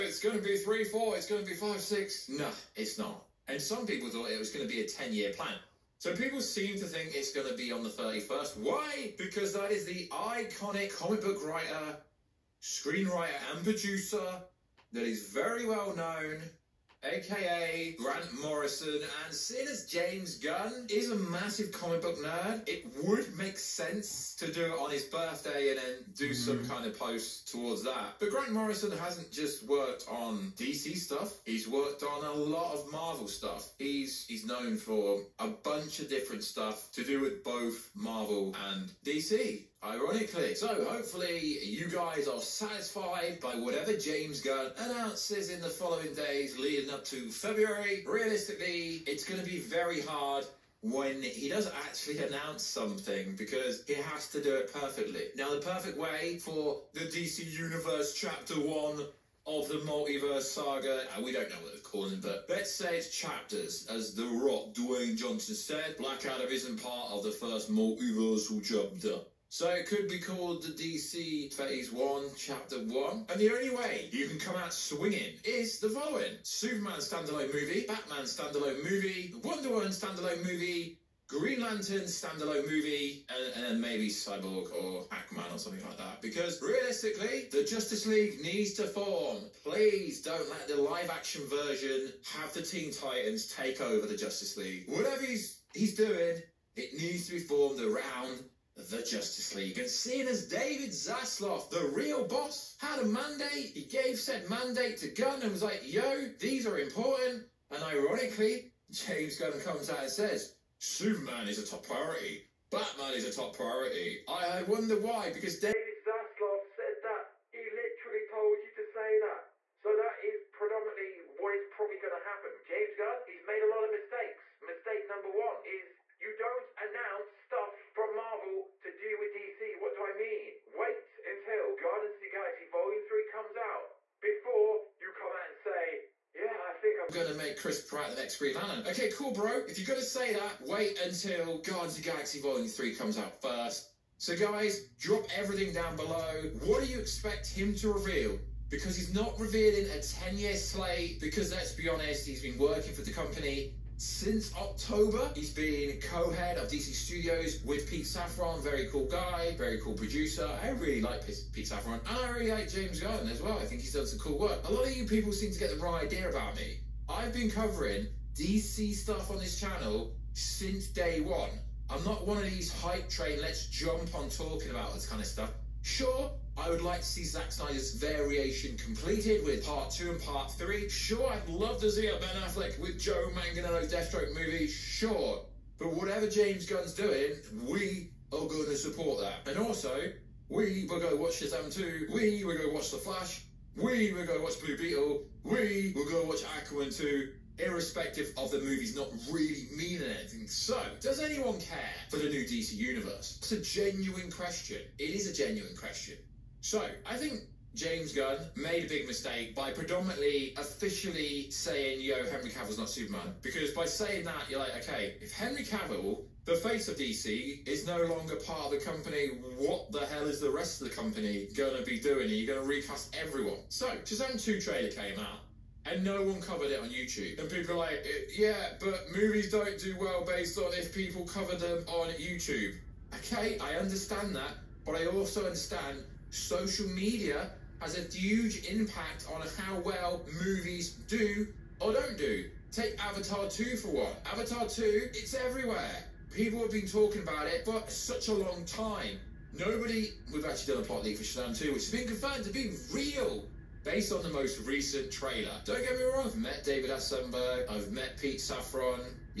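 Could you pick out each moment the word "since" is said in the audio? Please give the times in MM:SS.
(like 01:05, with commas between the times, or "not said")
02:34, 02:50.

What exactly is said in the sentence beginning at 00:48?
Realistically, it's going to be very hard when he does actually announce something because he has to do it perfectly.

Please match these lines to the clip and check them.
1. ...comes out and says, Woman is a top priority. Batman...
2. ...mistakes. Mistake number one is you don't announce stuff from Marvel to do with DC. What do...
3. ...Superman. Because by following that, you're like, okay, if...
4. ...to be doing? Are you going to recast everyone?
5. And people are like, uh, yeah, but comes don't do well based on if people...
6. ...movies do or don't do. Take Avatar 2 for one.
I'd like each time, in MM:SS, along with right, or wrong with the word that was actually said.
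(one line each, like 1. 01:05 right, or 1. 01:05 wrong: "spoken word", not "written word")
1. 01:49 wrong: "Superman", not "Woman"
2. 02:03 right
3. 03:32 wrong: "saying", not "following"
4. 03:41 right
5. 03:47 wrong: "movies", not "comes"
6. 04:00 right.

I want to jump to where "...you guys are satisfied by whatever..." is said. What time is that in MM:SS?
00:41.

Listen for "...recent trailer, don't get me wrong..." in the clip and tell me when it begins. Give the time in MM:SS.
04:14.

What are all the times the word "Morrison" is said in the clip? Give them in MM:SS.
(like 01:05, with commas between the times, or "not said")
00:18, 00:28.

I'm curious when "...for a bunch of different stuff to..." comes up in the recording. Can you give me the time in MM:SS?
00:34.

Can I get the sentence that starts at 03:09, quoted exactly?
And also, we will go watch Shazam 2.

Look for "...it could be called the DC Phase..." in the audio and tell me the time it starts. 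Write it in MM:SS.
01:09.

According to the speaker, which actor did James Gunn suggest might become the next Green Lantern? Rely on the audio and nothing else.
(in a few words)
Chris Pratt.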